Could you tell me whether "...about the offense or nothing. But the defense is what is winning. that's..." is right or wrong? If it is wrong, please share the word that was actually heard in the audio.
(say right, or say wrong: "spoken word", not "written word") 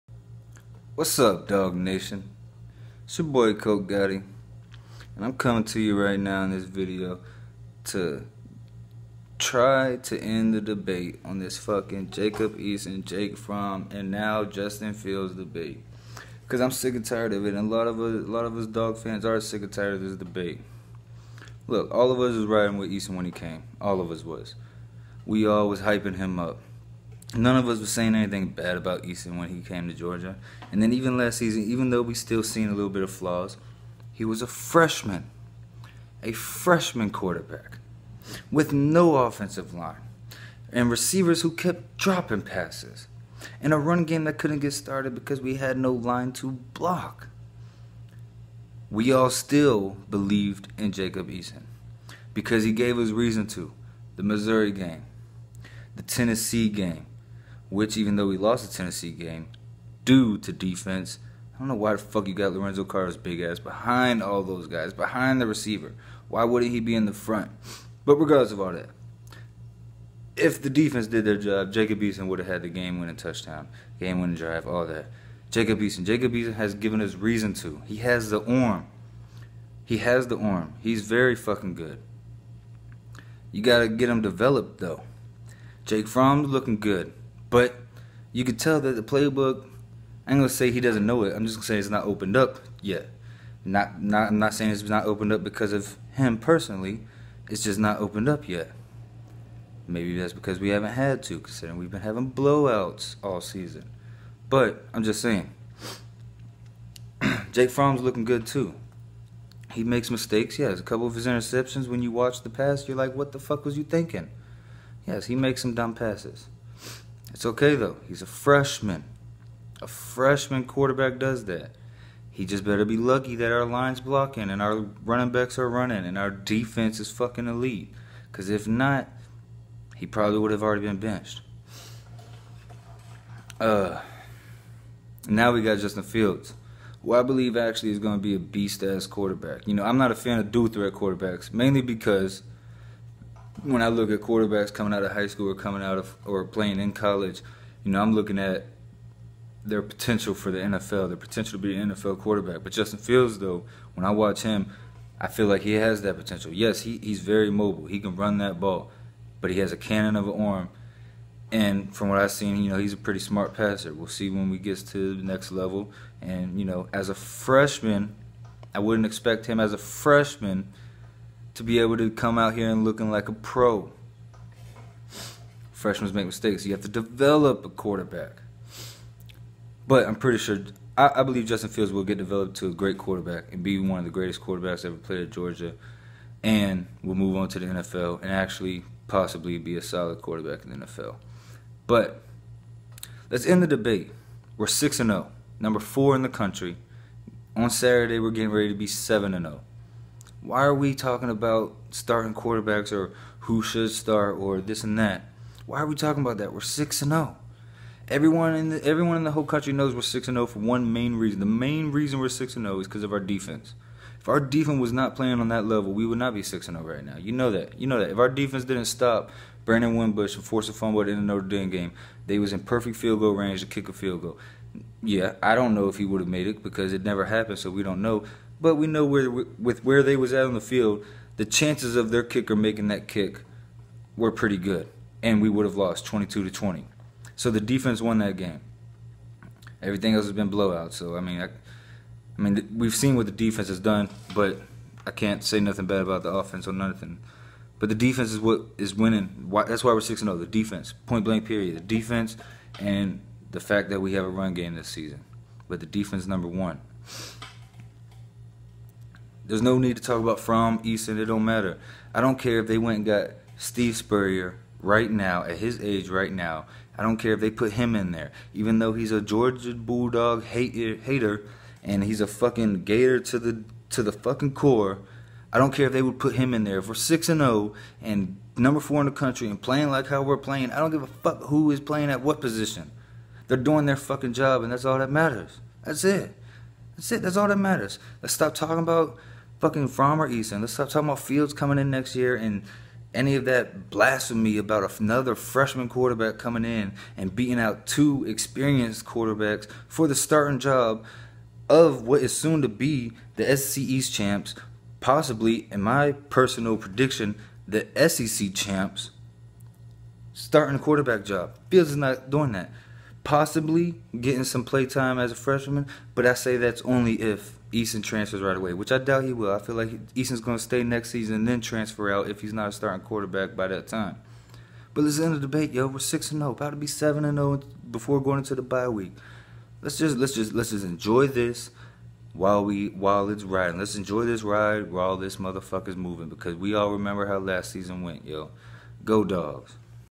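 right.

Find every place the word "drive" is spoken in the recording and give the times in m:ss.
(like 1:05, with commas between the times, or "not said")
1:14.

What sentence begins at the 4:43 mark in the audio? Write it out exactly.
They're doing their fucking job and that's all that matters.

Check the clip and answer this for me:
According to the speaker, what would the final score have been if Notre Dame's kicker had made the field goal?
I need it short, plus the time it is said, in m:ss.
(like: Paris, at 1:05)
22 to 20, at 3:56.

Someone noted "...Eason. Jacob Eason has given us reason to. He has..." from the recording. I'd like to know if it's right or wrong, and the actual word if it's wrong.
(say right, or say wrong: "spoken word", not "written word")
right.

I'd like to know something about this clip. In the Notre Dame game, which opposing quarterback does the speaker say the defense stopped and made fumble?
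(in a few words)
Brandon Wimbush.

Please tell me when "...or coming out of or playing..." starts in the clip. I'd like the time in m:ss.
2:25.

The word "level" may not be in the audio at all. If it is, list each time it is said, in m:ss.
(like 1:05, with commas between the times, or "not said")
2:45, 3:35.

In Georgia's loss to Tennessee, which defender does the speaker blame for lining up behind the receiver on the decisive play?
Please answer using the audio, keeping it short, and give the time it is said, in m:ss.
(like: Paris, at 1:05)
Lorenzo Carter, at 1:02.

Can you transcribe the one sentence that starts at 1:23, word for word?
You gotta get him developed though.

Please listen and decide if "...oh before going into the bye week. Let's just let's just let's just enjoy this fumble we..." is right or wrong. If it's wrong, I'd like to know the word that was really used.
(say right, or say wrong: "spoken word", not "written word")
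wrong: "while", not "fumble".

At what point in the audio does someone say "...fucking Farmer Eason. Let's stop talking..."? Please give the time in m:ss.
4:49.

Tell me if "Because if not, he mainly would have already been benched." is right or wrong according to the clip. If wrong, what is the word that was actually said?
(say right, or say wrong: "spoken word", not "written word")
wrong: "probably", not "mainly".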